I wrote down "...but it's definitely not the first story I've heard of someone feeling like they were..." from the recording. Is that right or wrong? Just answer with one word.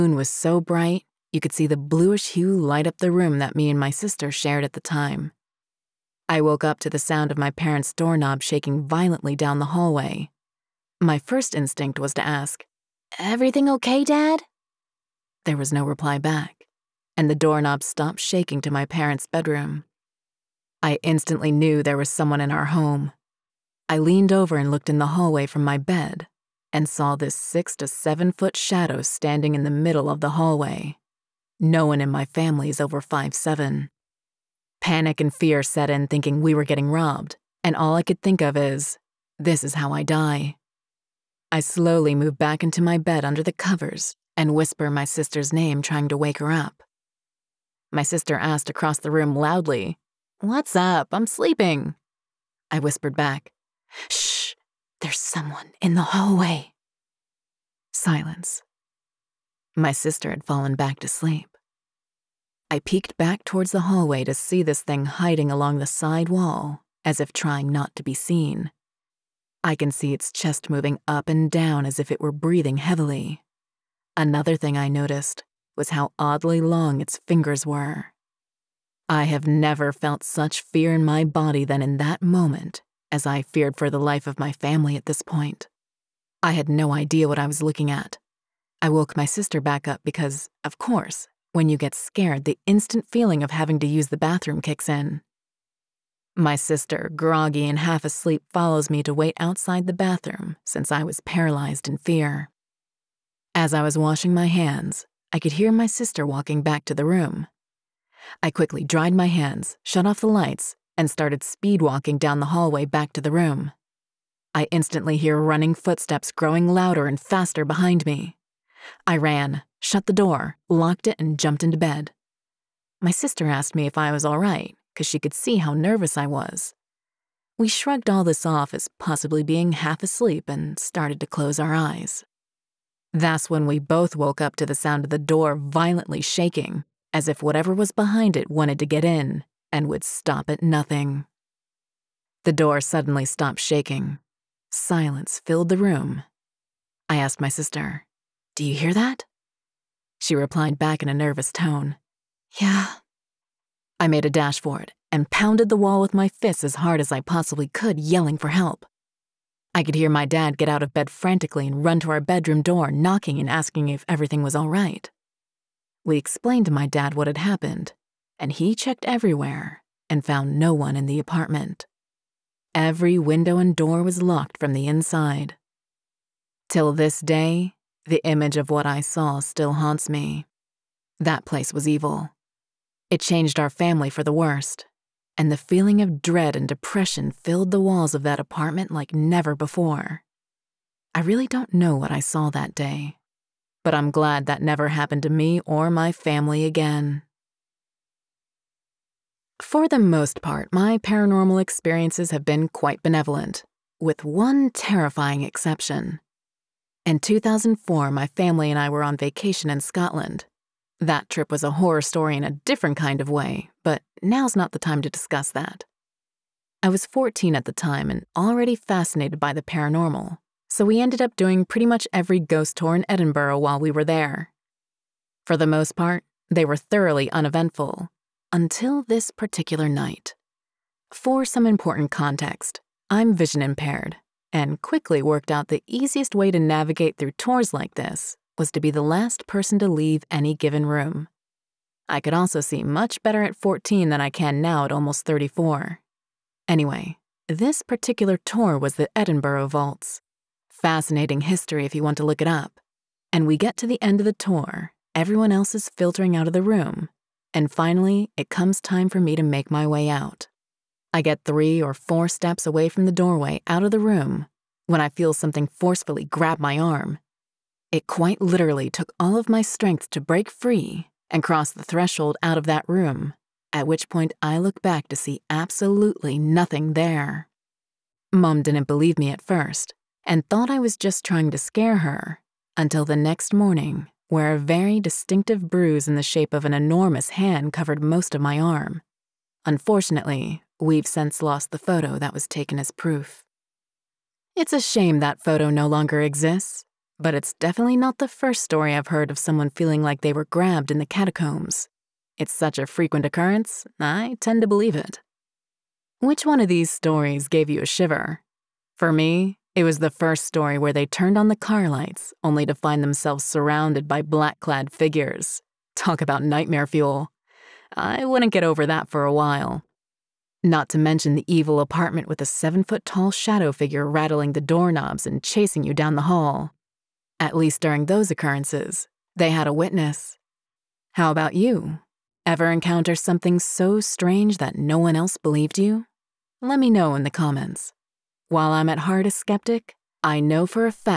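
right.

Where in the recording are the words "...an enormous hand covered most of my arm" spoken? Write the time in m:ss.
4:46.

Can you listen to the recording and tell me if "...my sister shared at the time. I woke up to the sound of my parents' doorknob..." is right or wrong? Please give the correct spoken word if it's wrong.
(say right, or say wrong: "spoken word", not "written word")
right.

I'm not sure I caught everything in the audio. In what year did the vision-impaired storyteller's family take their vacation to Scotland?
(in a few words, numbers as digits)
2004.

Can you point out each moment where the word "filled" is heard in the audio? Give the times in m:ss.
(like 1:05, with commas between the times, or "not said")
2:25, 3:07.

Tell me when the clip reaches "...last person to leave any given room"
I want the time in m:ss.
3:59.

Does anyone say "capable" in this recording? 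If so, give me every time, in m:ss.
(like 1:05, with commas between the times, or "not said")
not said.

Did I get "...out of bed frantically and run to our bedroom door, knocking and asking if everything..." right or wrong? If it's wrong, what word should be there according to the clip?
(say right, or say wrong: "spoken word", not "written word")
right.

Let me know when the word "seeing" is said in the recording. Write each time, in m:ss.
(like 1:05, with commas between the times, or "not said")
not said.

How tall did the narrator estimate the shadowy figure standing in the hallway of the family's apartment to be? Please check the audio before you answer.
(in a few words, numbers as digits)
6 to 7 feet.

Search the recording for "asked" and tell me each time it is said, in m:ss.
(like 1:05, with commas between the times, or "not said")
0:48, 2:03, 2:27.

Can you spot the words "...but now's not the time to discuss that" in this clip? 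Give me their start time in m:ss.
3:33.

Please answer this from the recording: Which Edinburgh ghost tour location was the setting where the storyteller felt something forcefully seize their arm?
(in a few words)
Edinburgh Vaults.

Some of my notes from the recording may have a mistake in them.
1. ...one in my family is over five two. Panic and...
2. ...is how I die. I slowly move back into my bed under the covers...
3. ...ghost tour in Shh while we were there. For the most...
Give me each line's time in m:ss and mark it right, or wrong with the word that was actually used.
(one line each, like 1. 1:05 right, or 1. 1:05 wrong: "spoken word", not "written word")
1. 0:31 wrong: "seven", not "two"
2. 0:39 right
3. 3:42 wrong: "Edinburgh", not "Shh".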